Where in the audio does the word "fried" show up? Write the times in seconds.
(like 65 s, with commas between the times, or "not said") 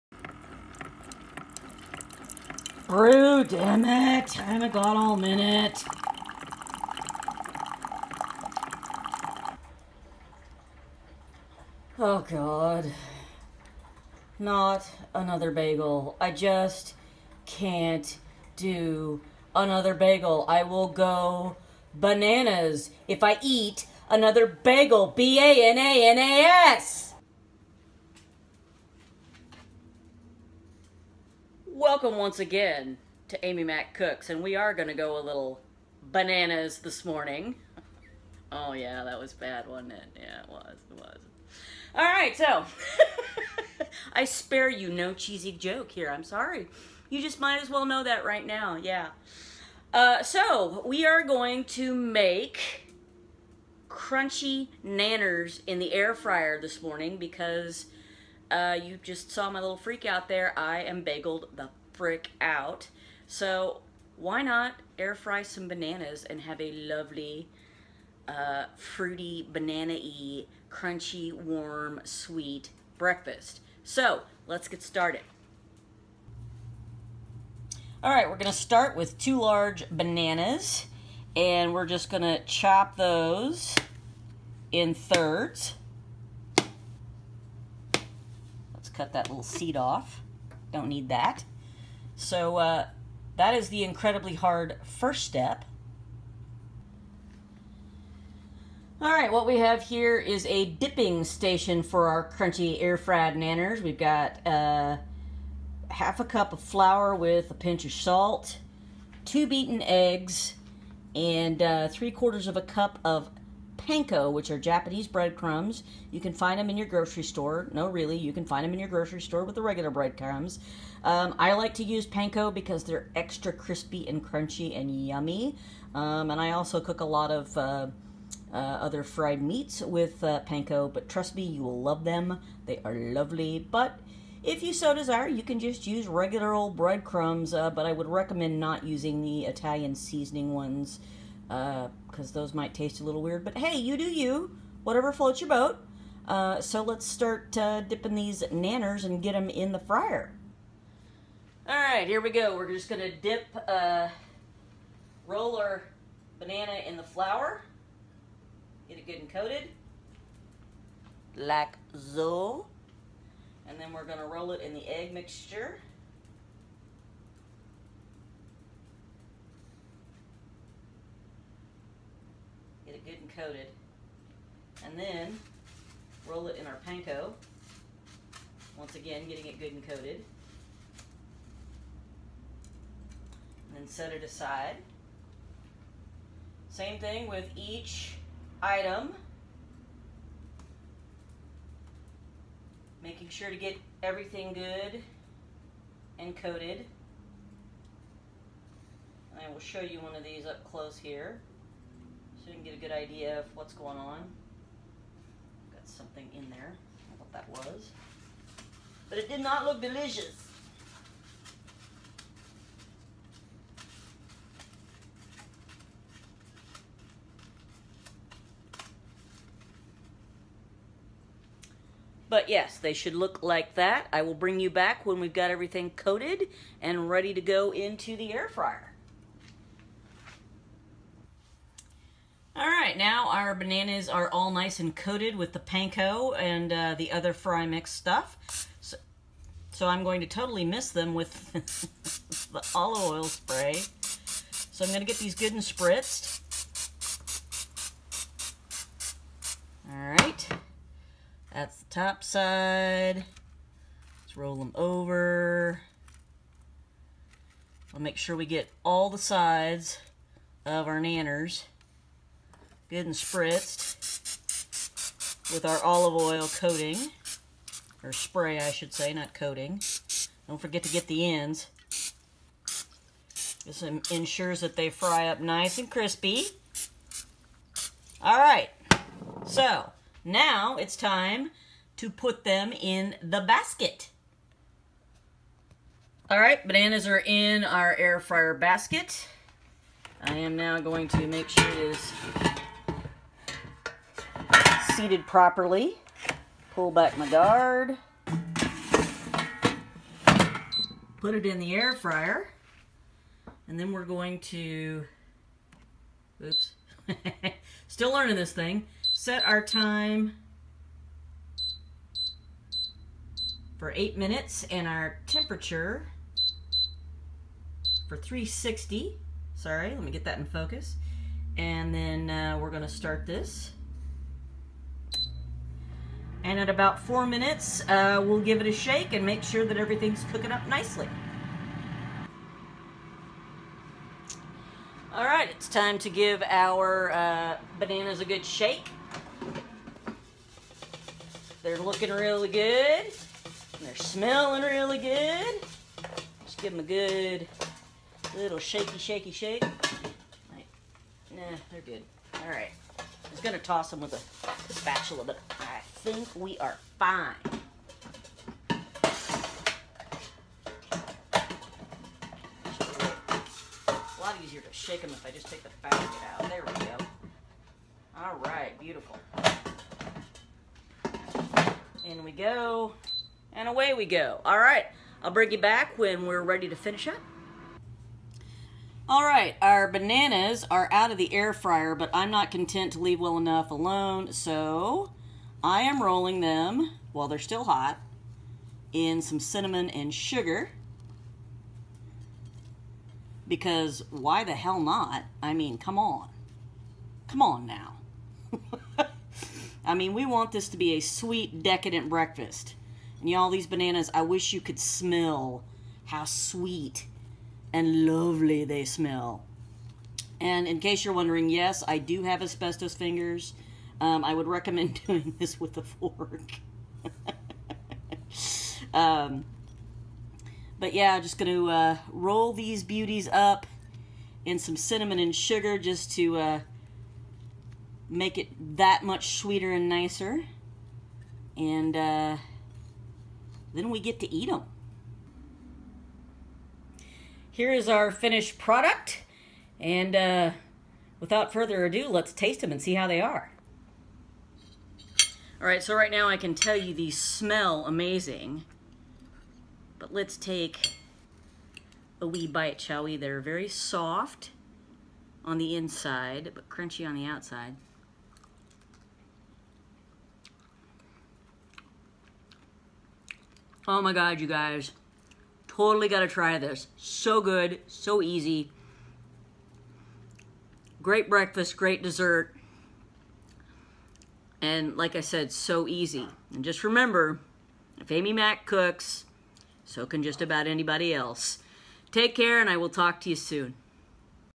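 102 s, 129 s.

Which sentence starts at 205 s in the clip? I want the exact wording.
Got something in there, what that was.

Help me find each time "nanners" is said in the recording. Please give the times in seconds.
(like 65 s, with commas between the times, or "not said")
54 s, 103 s, 148 s, 260 s.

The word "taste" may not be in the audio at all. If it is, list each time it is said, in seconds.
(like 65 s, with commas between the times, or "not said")
142 s, 442 s.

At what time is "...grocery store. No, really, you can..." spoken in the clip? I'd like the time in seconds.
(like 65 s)
116 s.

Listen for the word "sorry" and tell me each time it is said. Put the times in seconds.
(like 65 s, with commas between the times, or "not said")
46 s, 319 s.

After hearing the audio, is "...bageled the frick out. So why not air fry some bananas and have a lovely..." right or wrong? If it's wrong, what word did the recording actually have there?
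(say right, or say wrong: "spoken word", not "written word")
right.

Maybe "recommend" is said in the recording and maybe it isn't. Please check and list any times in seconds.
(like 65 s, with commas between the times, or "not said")
138 s, 414 s.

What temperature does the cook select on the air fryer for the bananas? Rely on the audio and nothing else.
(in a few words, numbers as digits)
360.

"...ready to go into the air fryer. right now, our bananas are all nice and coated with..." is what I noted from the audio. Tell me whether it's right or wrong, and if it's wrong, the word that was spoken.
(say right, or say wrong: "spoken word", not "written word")
right.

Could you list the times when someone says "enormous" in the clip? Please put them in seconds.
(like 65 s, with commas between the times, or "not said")
not said.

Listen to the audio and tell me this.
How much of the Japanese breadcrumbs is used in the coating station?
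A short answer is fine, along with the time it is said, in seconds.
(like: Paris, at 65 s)
3/4 cup, at 111 s.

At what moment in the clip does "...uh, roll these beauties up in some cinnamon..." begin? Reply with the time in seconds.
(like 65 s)
421 s.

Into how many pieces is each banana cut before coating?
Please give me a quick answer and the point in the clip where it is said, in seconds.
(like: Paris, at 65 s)
thirds, at 84 s.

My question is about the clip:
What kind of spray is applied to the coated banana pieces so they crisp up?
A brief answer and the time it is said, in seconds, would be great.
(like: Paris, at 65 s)
olive oil spray, at 242 s.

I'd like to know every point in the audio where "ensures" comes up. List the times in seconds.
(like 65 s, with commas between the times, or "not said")
273 s.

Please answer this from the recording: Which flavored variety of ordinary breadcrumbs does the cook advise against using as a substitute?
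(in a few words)
Italian seasoning.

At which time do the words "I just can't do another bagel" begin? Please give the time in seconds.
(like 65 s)
16 s.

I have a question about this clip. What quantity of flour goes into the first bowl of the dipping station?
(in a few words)
half a cup.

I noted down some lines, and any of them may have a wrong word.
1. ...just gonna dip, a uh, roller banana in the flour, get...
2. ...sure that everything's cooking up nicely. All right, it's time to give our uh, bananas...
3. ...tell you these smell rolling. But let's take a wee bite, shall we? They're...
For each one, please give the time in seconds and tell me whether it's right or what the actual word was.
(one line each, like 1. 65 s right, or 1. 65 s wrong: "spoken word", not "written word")
1. 152 s right
2. 329 s right
3. 446 s wrong: "amazing", not "rolling".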